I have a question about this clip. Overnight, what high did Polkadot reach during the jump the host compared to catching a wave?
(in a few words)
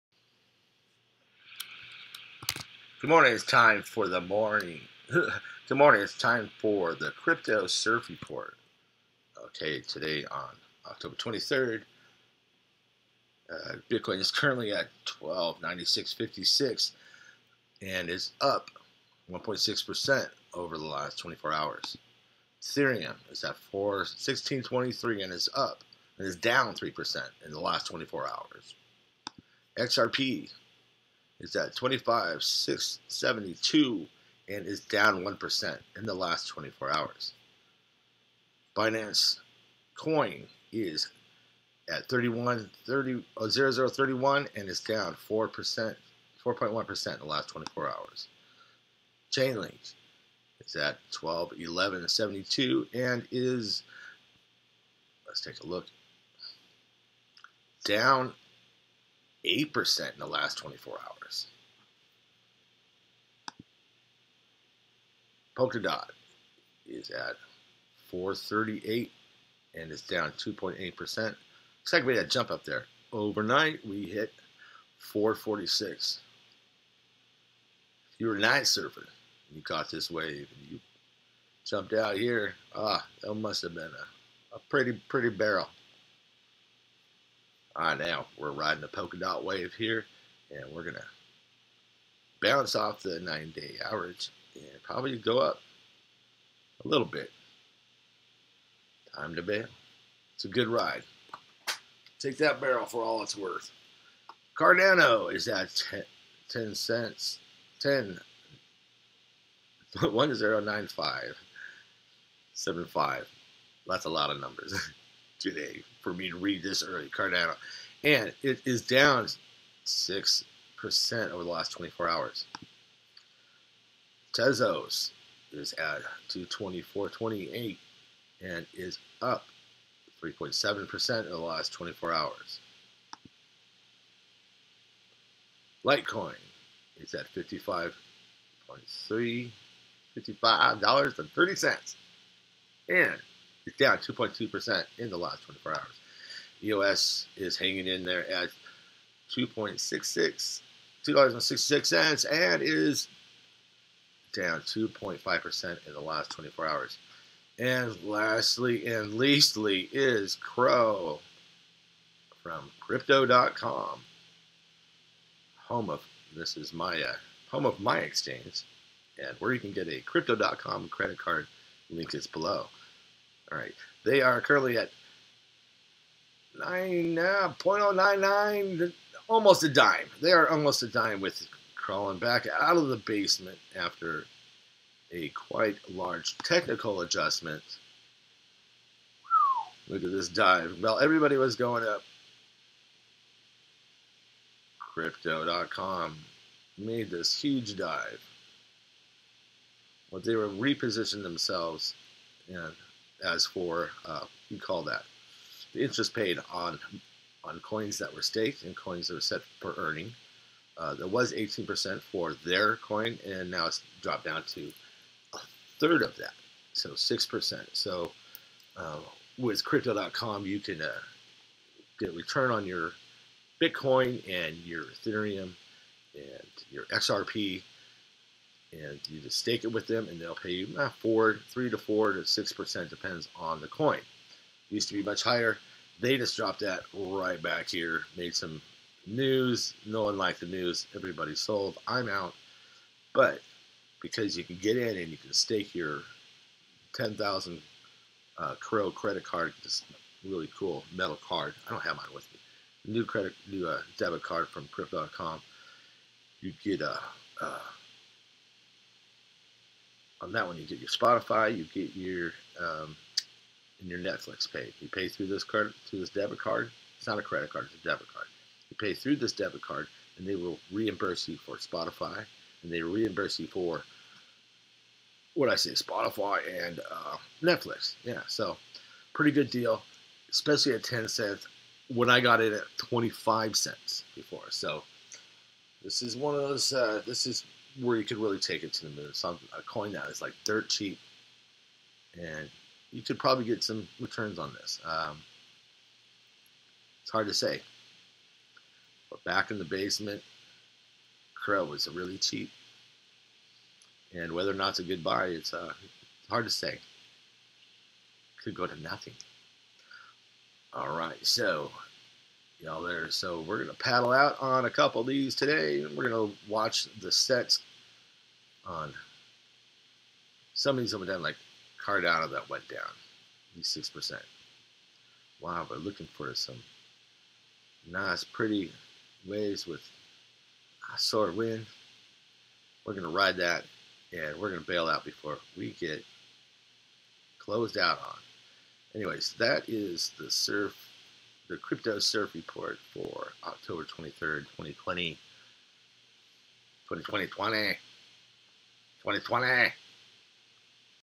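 446.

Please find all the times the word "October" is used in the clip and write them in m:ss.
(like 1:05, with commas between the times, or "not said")
0:10, 5:43.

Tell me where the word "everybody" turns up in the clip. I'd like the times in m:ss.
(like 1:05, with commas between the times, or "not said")
3:10, 4:00.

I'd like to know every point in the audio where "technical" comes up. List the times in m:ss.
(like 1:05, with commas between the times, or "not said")
3:06.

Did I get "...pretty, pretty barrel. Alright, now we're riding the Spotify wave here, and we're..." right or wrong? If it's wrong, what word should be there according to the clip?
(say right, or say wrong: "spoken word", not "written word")
wrong: "Polkadot", not "Spotify".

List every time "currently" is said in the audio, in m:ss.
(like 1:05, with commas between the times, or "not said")
0:14, 2:54.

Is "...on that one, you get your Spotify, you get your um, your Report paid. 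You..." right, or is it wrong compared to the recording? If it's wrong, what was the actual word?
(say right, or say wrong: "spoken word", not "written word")
wrong: "Netflix", not "Report".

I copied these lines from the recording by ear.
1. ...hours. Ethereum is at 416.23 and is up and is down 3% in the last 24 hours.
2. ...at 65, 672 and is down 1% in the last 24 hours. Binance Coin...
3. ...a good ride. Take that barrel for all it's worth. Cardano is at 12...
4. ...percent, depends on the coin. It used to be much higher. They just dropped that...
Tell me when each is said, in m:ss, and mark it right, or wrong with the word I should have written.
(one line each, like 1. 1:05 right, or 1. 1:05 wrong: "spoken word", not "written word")
1. 0:21 right
2. 0:31 wrong: "25", not "65"
3. 1:40 wrong: "10", not "12"
4. 3:52 right.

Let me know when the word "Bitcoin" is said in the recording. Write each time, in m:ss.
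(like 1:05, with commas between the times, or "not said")
0:13, 3:43.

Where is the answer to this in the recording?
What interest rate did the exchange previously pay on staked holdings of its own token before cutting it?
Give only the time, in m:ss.
3:31.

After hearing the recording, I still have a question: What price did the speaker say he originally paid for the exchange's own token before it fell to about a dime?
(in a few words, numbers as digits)
25 cents.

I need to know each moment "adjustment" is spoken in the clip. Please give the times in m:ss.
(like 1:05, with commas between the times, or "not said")
3:07.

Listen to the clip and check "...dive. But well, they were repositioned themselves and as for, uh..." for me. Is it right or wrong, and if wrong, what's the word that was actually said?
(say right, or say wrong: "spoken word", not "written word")
right.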